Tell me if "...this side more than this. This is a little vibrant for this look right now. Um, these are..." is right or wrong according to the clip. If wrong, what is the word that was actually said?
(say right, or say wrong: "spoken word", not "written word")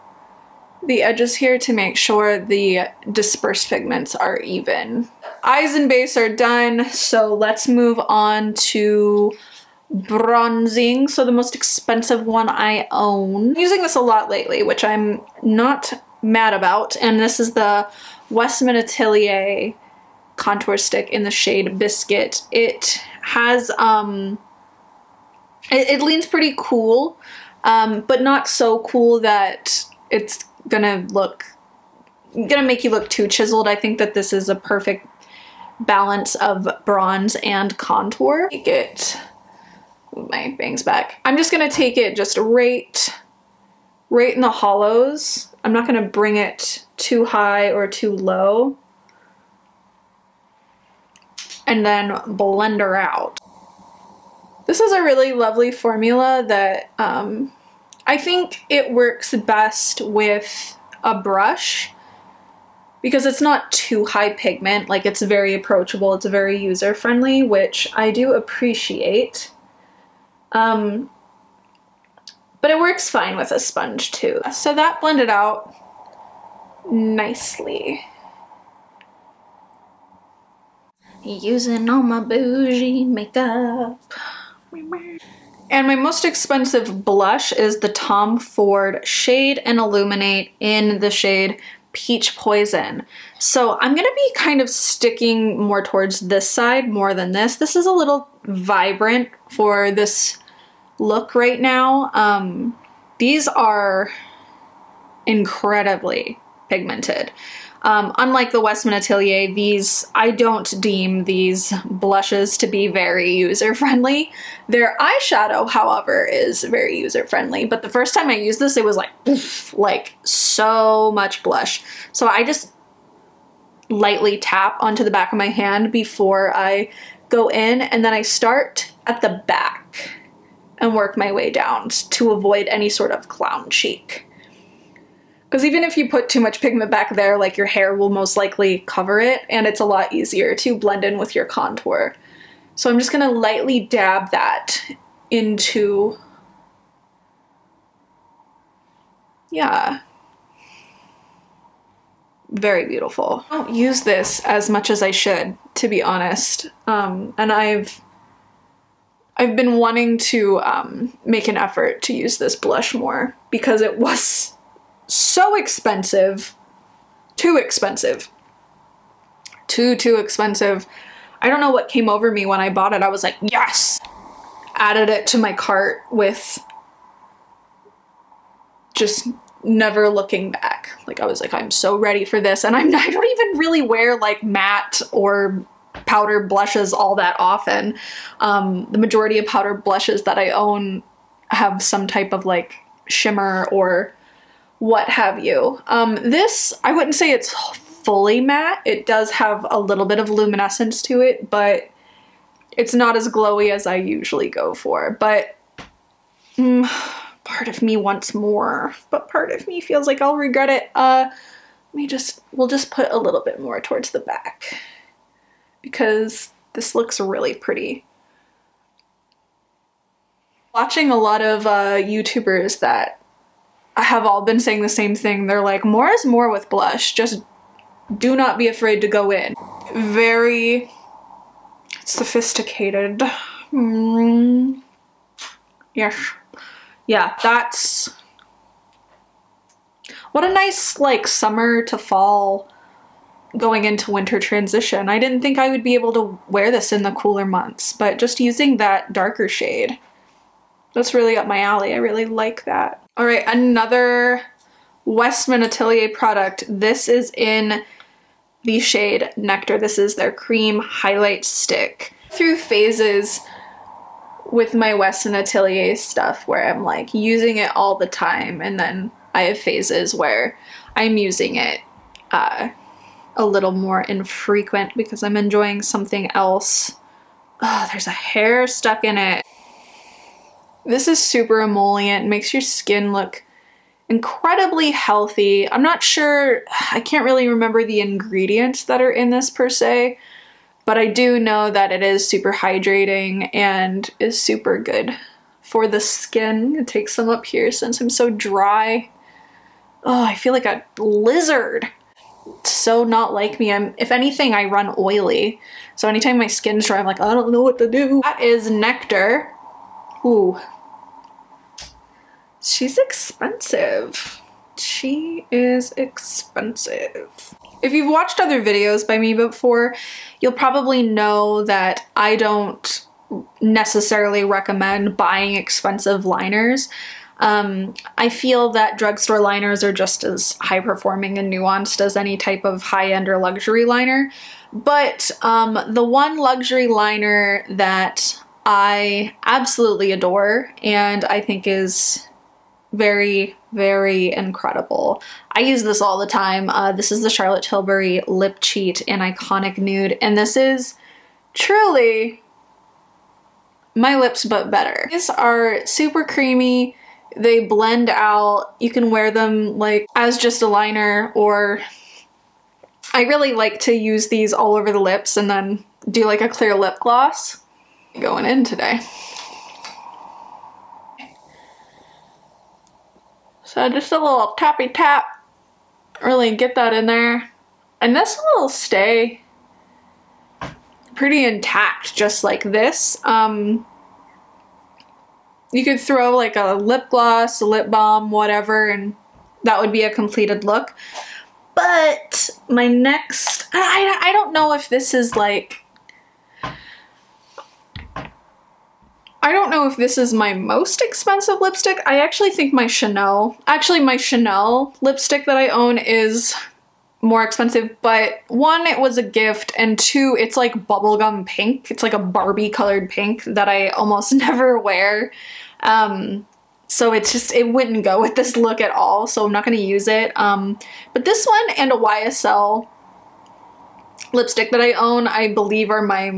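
right.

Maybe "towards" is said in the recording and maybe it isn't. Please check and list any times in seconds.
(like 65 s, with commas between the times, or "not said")
95 s, 213 s.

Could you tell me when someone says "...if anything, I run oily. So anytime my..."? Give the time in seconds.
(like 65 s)
303 s.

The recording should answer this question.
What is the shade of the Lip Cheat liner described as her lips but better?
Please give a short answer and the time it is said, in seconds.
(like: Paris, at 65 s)
Iconic Nude, at 349 s.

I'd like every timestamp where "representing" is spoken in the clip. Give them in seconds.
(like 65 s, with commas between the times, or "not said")
not said.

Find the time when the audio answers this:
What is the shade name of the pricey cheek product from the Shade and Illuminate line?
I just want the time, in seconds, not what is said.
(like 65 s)
91 s.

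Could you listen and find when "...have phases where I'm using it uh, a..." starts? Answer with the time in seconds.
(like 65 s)
269 s.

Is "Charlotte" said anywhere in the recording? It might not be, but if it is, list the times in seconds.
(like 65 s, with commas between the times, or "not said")
347 s.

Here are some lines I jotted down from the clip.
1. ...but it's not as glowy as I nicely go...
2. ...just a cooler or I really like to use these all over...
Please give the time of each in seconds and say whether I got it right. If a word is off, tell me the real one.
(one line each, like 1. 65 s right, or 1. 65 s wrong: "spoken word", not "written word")
1. 201 s wrong: "usually", not "nicely"
2. 360 s wrong: "liner", not "cooler".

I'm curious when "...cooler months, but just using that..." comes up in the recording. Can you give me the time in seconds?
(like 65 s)
247 s.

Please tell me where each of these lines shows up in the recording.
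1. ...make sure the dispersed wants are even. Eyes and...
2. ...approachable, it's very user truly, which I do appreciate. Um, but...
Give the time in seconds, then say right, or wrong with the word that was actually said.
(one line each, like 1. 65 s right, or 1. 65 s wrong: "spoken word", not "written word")
1. 1 s wrong: "pigments", not "wants"
2. 65 s wrong: "friendly", not "truly".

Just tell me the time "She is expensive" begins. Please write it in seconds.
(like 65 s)
314 s.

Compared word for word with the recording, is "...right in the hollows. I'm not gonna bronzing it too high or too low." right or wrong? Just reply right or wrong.
wrong.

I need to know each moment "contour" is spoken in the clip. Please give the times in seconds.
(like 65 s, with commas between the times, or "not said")
20 s, 37 s, 141 s.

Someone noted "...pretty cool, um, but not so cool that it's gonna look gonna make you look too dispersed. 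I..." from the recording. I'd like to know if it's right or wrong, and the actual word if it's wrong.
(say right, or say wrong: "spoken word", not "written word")
wrong: "chiseled", not "dispersed".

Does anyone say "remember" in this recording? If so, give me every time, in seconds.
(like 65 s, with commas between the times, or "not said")
287 s.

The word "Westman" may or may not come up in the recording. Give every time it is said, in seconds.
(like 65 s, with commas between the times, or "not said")
18 s, 108 s, 255 s, 264 s.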